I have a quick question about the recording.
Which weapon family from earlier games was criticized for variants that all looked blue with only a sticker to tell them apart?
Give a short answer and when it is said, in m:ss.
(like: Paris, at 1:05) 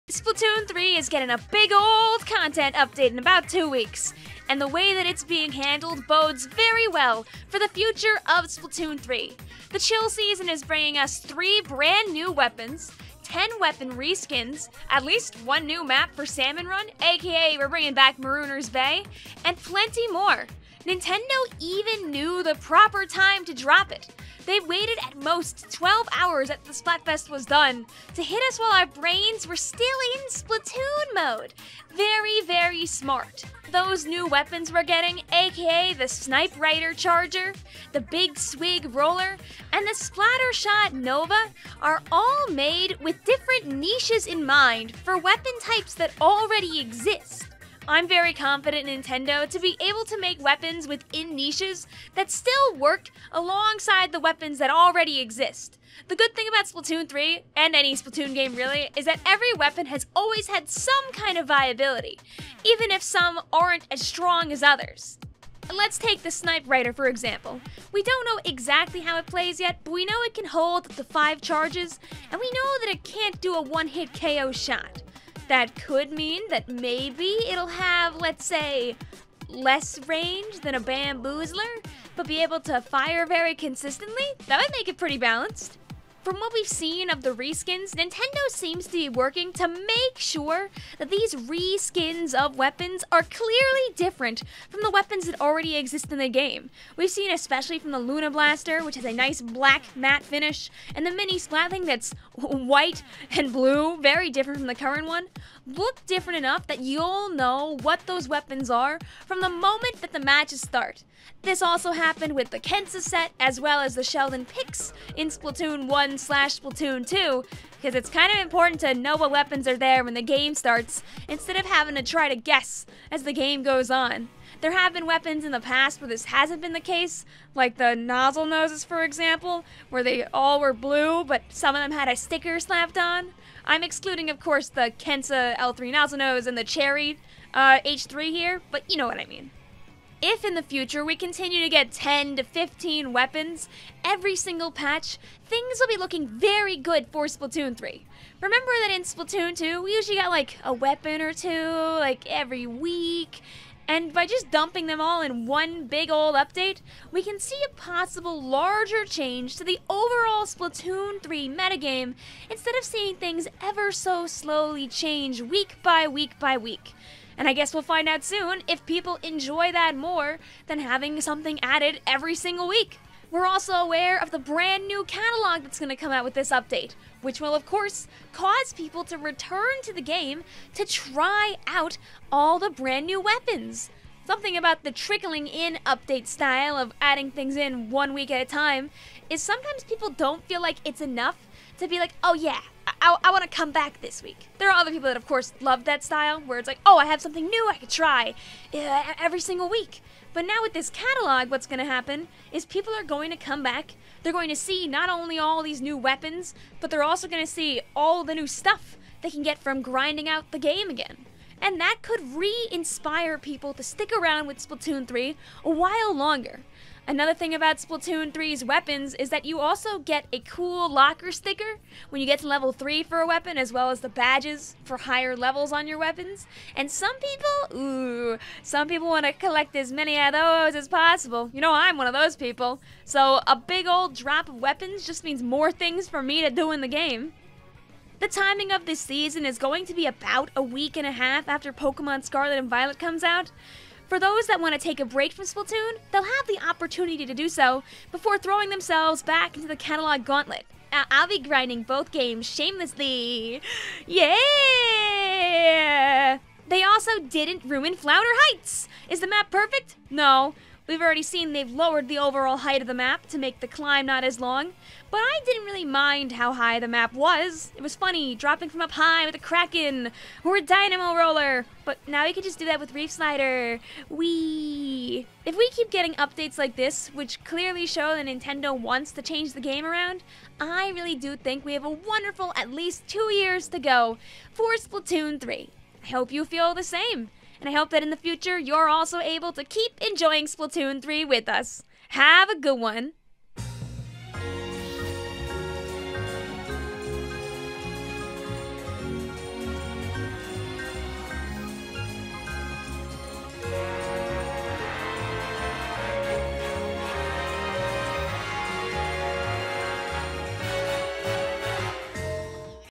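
Nozzlenose, at 2:07.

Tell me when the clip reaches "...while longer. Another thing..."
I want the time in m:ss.
3:35.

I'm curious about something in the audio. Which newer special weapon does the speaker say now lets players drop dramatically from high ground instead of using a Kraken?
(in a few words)
Reef Slider.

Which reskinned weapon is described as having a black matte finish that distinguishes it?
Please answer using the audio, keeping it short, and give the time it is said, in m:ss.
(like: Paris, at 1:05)
Luna Blaster, at 1:37.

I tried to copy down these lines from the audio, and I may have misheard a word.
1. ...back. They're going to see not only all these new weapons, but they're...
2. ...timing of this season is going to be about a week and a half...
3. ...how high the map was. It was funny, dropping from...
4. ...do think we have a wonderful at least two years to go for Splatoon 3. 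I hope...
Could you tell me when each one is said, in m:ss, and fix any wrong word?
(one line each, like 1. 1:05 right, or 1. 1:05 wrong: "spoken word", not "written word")
1. 3:23 right
2. 3:58 right
3. 4:26 right
4. 4:41 right.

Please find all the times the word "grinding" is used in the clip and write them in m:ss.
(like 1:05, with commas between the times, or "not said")
3:29, 4:11.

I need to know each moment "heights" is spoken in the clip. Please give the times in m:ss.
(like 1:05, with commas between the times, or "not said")
4:18, 4:22.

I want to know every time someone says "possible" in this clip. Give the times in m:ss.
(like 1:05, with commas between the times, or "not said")
2:37, 3:50.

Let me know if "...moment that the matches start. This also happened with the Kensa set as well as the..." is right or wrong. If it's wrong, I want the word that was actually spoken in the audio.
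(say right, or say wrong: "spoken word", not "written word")
right.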